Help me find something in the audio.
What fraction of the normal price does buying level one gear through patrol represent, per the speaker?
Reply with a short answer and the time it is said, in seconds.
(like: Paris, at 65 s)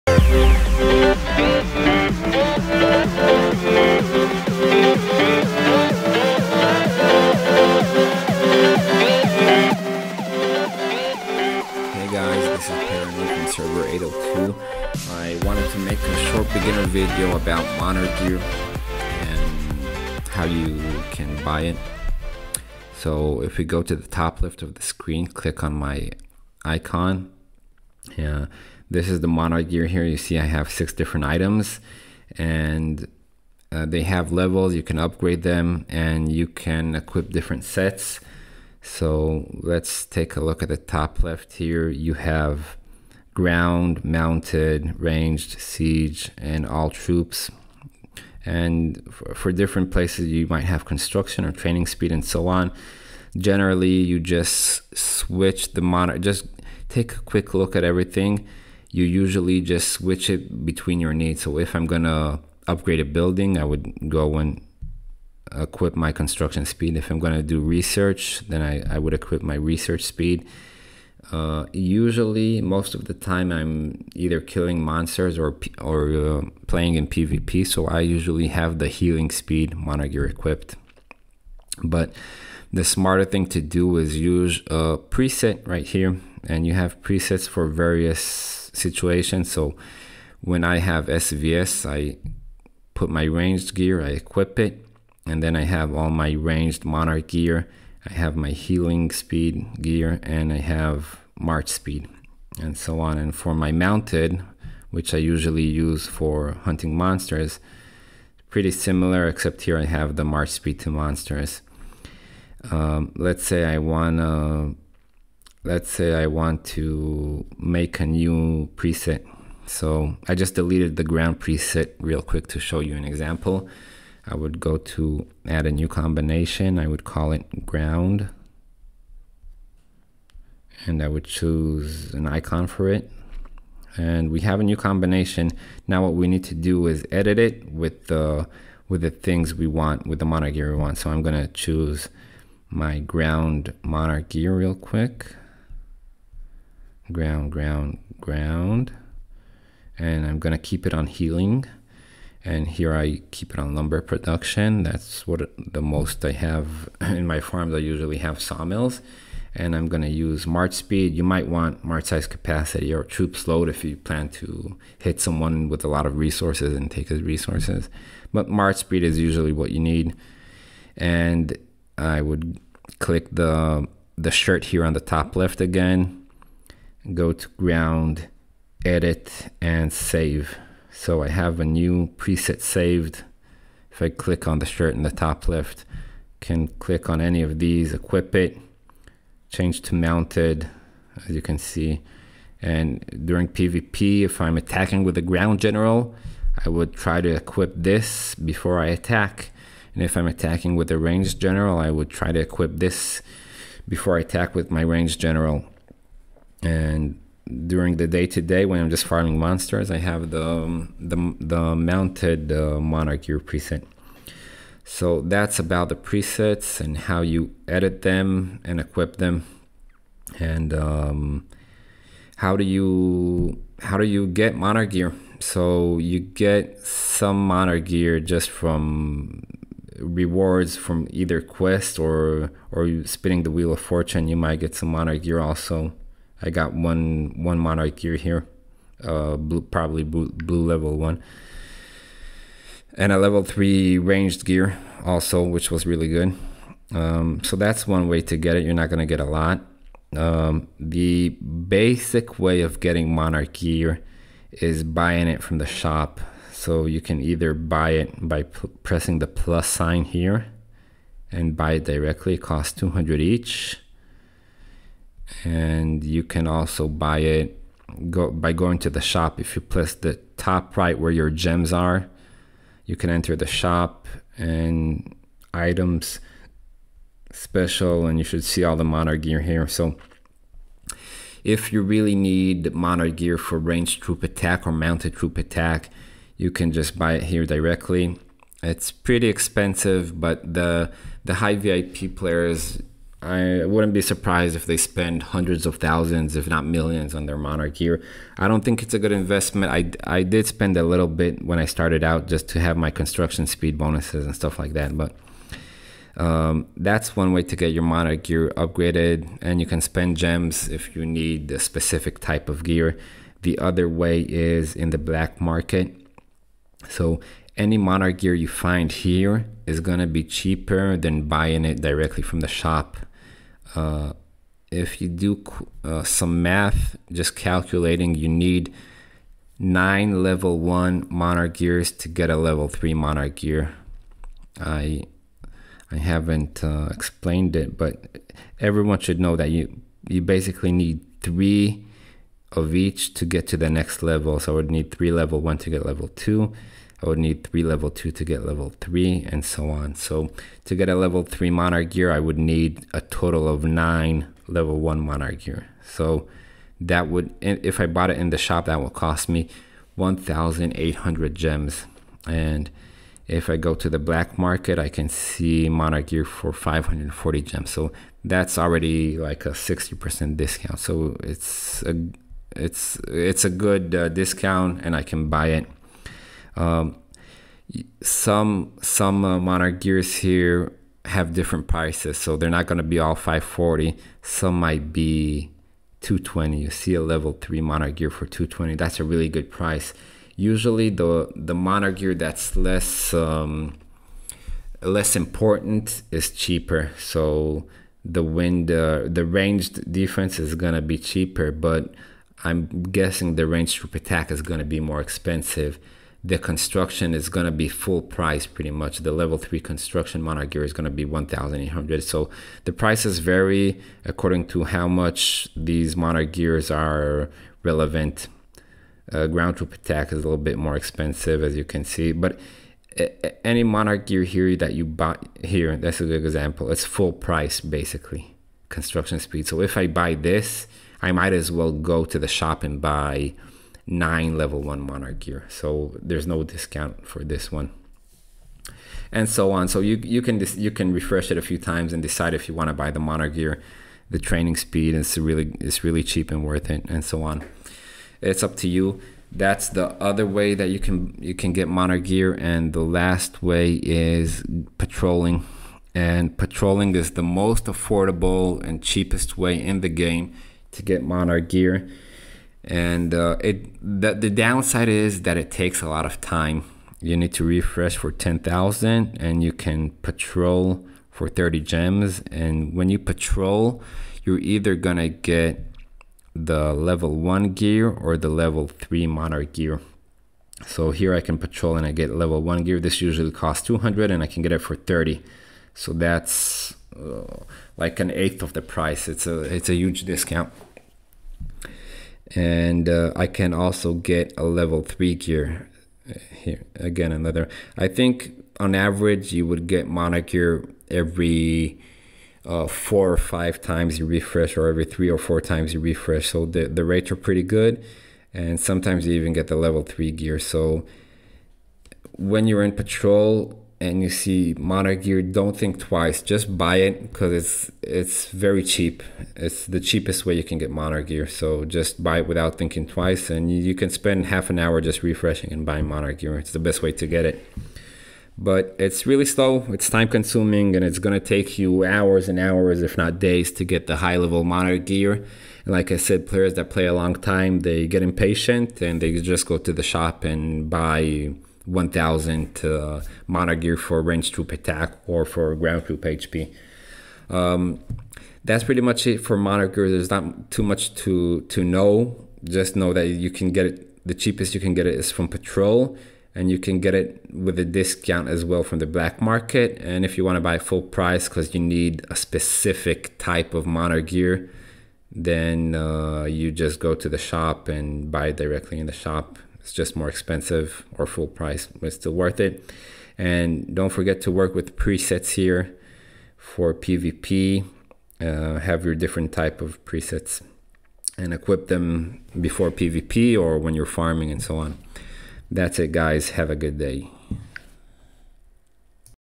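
An eighth, at 488 s.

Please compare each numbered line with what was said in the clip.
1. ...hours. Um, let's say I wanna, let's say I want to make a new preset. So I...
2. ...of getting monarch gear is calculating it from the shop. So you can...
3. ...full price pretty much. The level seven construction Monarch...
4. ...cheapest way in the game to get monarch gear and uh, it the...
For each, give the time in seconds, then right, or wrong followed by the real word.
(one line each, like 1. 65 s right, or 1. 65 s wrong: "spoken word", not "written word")
1. 110 s wrong: "monsters", not "hours"
2. 252 s wrong: "buying", not "calculating"
3. 407 s wrong: "three", not "seven"
4. 458 s right.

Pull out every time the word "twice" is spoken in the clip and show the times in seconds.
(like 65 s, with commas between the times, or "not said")
515 s, 522 s.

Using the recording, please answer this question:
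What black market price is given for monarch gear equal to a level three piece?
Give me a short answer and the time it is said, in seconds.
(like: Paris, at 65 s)
540 gems, at 366 s.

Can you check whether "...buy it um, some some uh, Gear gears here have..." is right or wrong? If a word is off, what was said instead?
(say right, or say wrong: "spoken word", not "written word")
wrong: "Monarch", not "Gear".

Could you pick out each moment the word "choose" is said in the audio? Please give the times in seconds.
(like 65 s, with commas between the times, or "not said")
131 s, 141 s.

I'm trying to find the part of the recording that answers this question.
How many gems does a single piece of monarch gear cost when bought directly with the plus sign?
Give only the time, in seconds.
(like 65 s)
262 s.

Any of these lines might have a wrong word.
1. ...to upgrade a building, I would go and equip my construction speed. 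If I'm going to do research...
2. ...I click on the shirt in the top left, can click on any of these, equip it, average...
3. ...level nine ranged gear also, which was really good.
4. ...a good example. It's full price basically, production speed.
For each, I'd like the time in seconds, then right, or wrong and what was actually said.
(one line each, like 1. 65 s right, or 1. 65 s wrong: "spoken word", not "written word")
1. 62 s right
2. 184 s wrong: "change", not "average"
3. 243 s wrong: "three", not "nine"
4. 426 s wrong: "construction", not "production".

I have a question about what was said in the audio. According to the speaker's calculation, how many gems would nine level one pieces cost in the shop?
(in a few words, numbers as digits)
1,800.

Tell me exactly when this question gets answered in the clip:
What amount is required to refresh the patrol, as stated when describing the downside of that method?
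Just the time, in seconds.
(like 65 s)
468 s.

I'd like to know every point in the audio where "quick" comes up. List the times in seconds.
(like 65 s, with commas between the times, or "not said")
57 s, 122 s, 144 s.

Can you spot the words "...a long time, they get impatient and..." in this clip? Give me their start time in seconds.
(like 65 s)
536 s.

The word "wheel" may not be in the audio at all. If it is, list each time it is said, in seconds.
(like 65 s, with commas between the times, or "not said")
233 s.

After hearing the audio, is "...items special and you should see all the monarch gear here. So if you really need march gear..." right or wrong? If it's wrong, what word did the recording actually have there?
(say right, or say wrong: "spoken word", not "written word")
wrong: "monarch", not "march".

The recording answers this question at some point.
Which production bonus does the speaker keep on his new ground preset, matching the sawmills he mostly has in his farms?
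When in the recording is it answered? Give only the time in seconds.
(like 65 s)
153 s.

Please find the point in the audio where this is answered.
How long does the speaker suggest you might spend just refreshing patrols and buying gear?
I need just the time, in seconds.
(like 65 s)
524 s.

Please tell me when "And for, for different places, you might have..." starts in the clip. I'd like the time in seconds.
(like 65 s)
48 s.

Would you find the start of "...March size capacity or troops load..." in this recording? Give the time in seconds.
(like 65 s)
161 s.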